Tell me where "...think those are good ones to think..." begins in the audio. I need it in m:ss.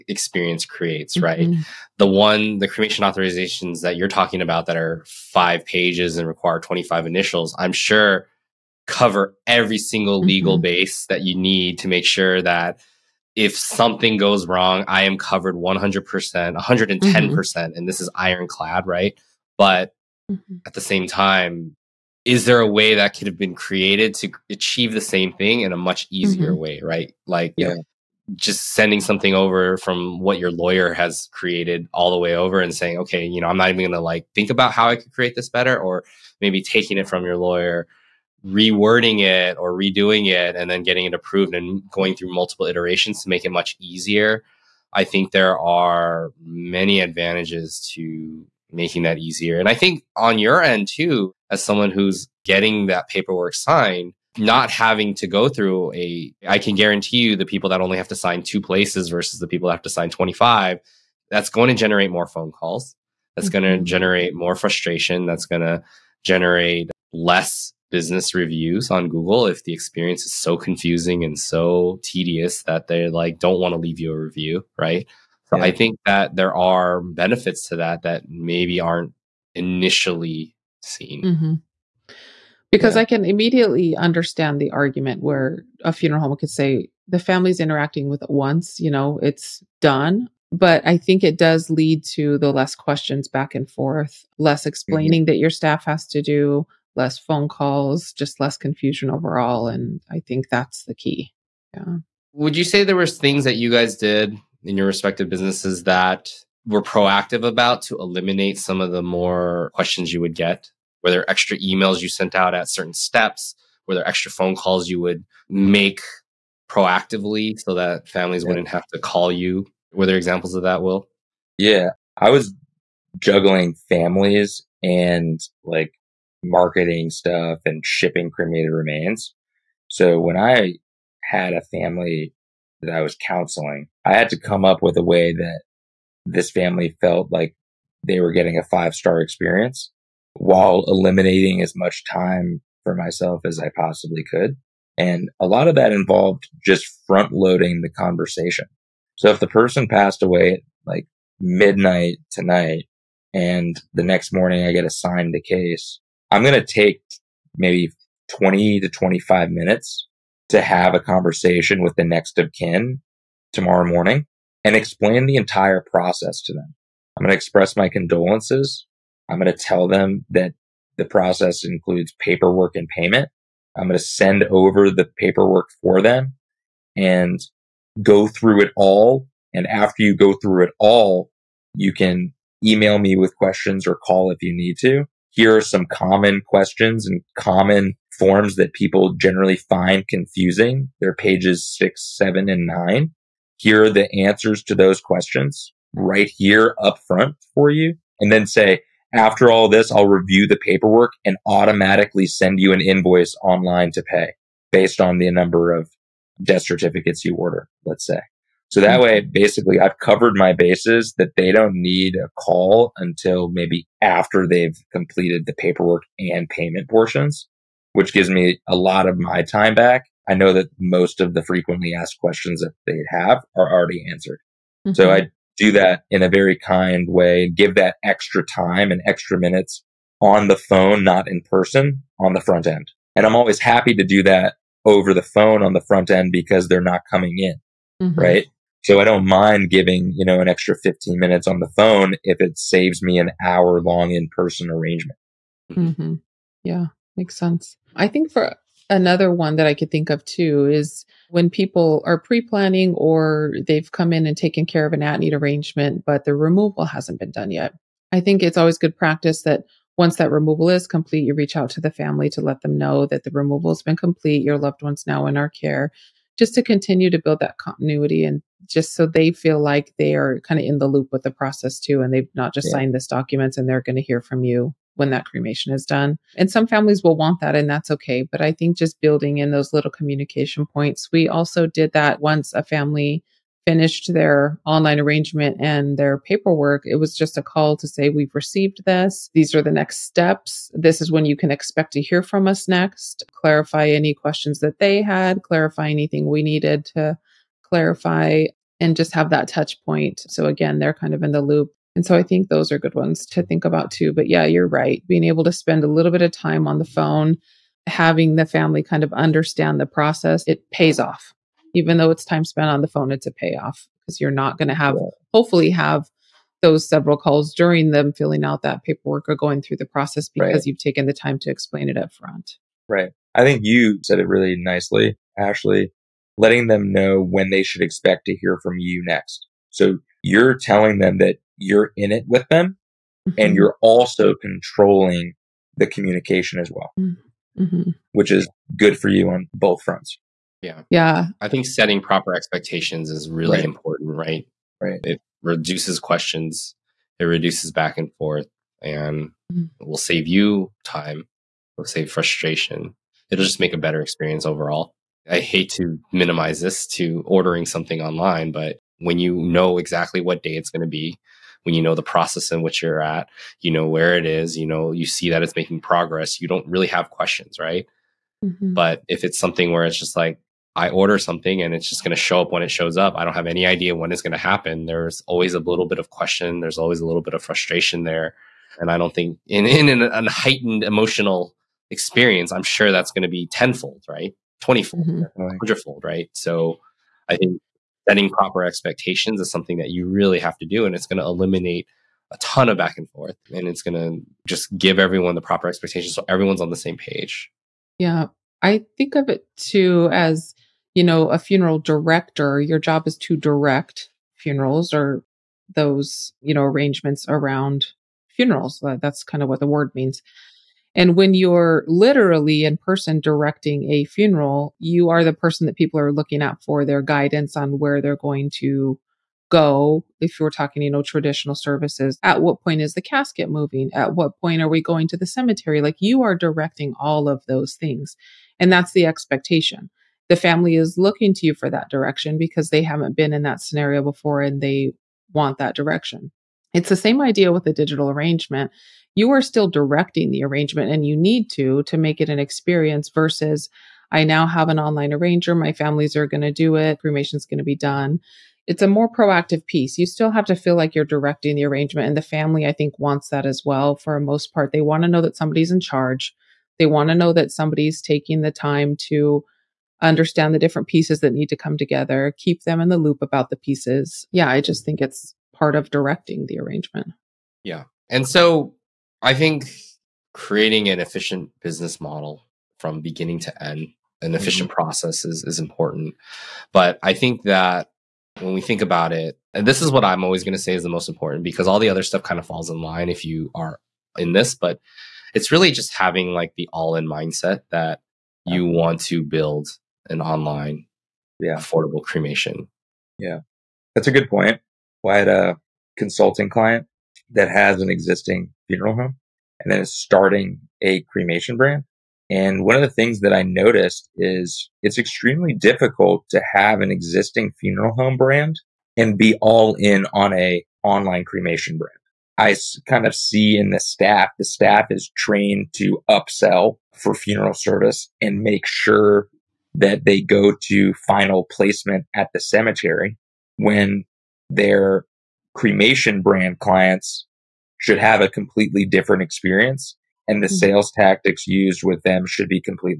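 5:02.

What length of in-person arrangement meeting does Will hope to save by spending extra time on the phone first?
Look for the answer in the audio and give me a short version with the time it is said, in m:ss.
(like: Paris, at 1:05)
An hour, at 4:03.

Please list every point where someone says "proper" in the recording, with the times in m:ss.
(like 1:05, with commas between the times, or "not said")
5:42, 6:28, 6:35.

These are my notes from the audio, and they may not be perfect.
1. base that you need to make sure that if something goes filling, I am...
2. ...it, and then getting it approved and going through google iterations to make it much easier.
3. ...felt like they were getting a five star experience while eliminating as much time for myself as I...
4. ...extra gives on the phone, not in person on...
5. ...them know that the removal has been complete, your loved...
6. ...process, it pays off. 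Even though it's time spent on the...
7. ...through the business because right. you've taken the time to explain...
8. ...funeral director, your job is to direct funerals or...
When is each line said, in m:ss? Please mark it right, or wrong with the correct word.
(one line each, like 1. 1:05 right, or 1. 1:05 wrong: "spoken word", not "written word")
1. 0:10 wrong: "wrong", not "filling"
2. 0:40 wrong: "multiple", not "google"
3. 2:17 right
4. 3:49 wrong: "minutes", not "gives"
5. 4:22 right
6. 5:09 right
7. 5:19 wrong: "process", not "business"
8. 6:41 right.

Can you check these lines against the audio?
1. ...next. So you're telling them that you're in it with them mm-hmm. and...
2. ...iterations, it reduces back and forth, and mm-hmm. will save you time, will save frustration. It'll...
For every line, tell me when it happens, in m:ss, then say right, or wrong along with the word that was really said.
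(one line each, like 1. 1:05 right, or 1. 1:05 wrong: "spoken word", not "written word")
1. 5:29 right
2. 5:45 wrong: "questions", not "iterations".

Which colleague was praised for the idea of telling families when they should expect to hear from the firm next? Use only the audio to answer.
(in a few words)
Ashley.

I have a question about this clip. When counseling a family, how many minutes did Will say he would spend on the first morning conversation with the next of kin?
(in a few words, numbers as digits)
20 to 25 minutes.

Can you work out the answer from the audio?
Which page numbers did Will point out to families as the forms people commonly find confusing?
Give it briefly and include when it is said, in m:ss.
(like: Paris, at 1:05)
6, 7, and 9, at 3:11.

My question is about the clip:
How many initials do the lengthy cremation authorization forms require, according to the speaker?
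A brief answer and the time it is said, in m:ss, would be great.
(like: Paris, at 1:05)
25, at 0:06.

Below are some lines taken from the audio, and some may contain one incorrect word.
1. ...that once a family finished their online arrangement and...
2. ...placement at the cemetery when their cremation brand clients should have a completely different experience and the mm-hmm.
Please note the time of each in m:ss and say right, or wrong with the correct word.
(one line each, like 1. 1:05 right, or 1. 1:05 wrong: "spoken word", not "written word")
1. 4:41 right
2. 8:41 right.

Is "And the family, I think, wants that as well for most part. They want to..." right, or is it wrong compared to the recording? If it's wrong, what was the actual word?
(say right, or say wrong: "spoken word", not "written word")
right.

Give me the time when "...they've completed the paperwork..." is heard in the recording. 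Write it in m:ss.
3:34.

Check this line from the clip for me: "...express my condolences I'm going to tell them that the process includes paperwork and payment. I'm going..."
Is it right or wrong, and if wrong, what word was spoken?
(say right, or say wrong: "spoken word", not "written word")
right.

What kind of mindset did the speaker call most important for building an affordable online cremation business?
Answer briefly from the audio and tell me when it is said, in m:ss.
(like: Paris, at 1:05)
All in mindset, at 8:06.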